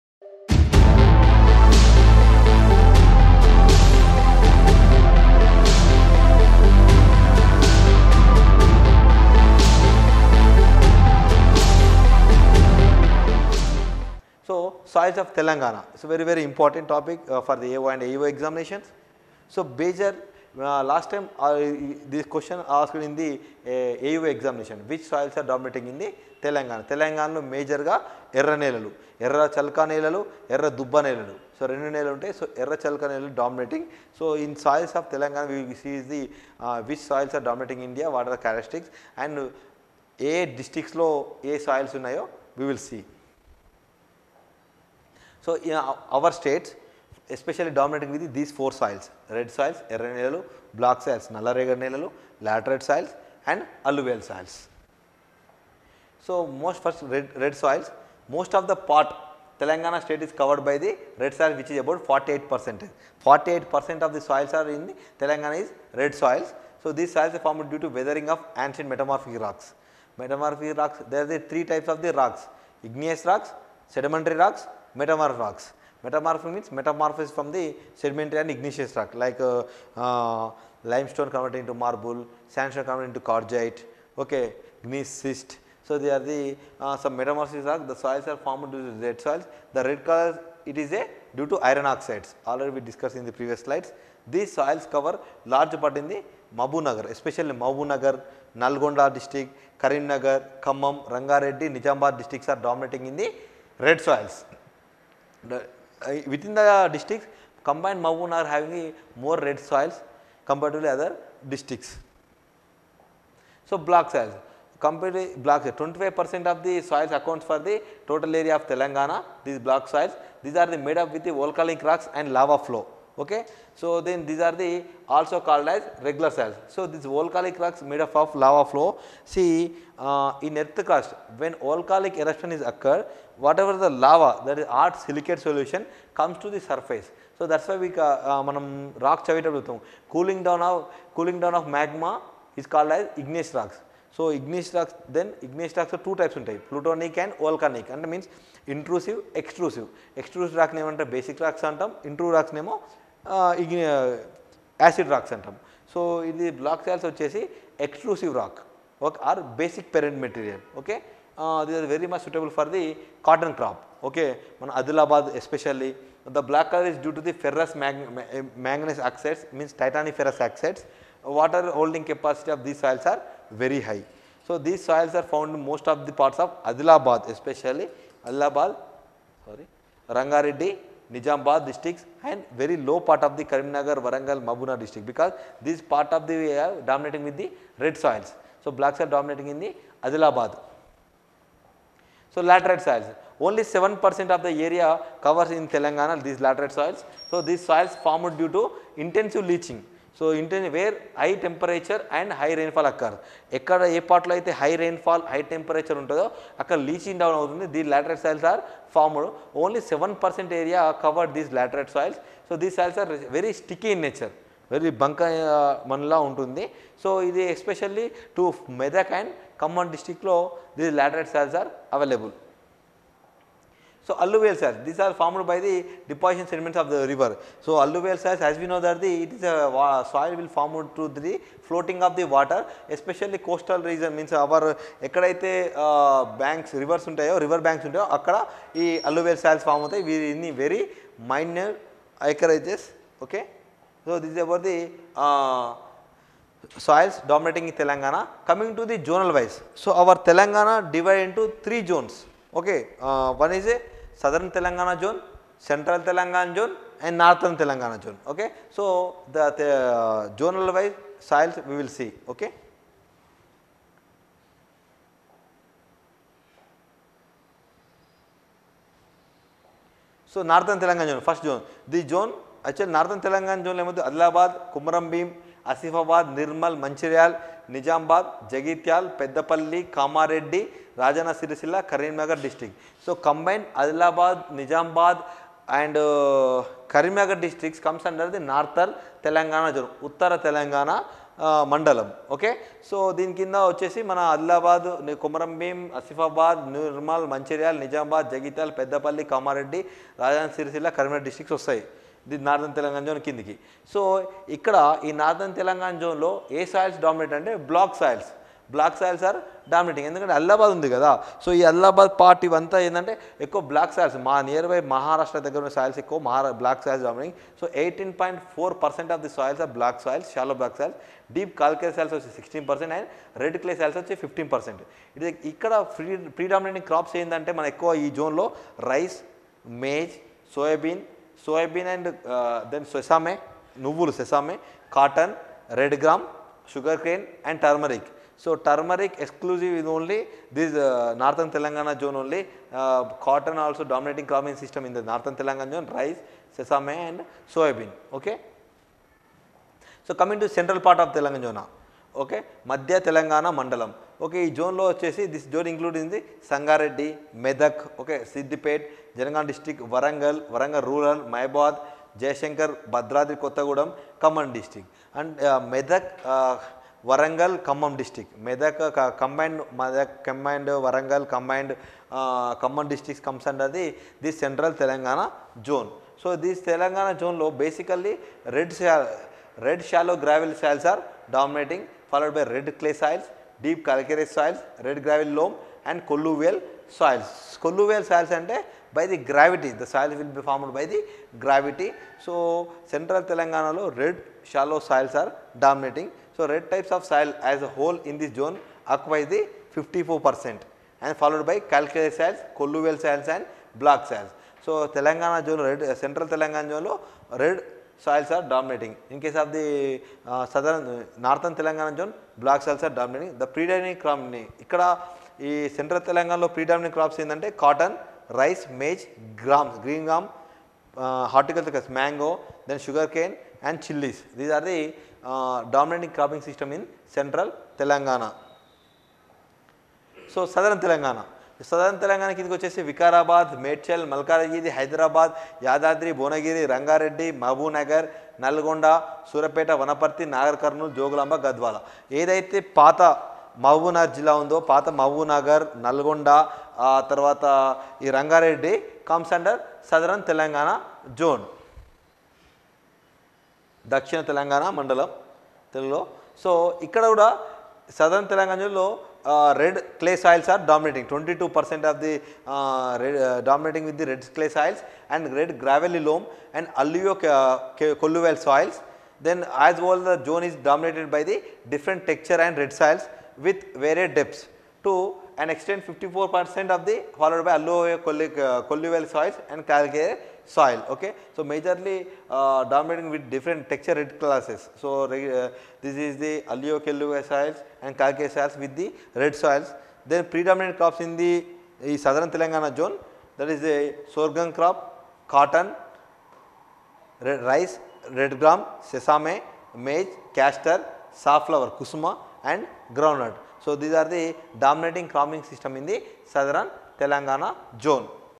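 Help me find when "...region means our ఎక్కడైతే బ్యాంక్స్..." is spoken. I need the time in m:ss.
3:53.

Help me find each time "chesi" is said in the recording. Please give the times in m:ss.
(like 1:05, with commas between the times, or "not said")
5:54.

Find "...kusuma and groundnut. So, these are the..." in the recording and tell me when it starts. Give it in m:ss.
8:21.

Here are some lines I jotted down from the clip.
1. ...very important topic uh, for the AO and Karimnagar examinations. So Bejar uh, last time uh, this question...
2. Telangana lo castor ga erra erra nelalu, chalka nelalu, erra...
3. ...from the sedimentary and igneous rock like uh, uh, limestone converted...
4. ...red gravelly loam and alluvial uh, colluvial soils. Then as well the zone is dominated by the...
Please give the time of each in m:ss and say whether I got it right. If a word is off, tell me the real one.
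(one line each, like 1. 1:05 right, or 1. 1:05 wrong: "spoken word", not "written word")
1. 0:16 wrong: "AEO", not "Karimnagar"
2. 0:26 wrong: "major", not "castor"
3. 1:17 right
4. 7:45 right.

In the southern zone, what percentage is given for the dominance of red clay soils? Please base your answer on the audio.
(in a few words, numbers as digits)
22 percent.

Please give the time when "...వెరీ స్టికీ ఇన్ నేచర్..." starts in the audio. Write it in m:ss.
3:33.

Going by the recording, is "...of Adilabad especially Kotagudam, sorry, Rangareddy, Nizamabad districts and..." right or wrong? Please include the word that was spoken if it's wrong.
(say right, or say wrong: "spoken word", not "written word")
wrong: "Allahabad", not "Kotagudam".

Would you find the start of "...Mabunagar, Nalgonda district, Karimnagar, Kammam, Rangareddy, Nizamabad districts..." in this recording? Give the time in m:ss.
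1:37.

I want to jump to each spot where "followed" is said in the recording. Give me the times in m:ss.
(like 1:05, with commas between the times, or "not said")
6:22, 6:41, 7:57.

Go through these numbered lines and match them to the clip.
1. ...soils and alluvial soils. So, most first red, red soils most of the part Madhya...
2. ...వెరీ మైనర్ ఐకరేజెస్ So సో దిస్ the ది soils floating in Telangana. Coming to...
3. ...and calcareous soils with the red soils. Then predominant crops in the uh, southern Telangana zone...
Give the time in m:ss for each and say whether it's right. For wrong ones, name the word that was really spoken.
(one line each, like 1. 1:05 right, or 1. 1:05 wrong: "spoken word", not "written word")
1. 0:52 wrong: "Telangana", not "Madhya"
2. 4:00 wrong: "dominating", not "floating"
3. 8:07 right.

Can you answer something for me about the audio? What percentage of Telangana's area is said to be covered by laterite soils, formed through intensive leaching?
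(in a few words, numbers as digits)
7 percent.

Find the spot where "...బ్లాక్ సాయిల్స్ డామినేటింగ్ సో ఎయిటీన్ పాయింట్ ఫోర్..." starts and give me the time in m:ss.
5:16.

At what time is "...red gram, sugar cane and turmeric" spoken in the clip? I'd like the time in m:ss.
5:35.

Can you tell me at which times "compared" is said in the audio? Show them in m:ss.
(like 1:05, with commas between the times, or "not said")
1:50, 1:54.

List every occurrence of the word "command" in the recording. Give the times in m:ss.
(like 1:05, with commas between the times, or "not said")
6:04, 6:11.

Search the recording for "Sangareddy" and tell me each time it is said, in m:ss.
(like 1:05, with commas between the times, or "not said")
5:56.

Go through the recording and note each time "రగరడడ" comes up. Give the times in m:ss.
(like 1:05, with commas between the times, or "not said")
7:16, 7:28.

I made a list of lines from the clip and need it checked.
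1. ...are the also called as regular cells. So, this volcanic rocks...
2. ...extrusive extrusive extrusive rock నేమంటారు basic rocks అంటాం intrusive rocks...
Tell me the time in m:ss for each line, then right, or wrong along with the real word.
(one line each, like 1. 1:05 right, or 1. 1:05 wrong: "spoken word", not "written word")
1. 2:04 right
2. 2:28 wrong: "intrusive", not "extrusive".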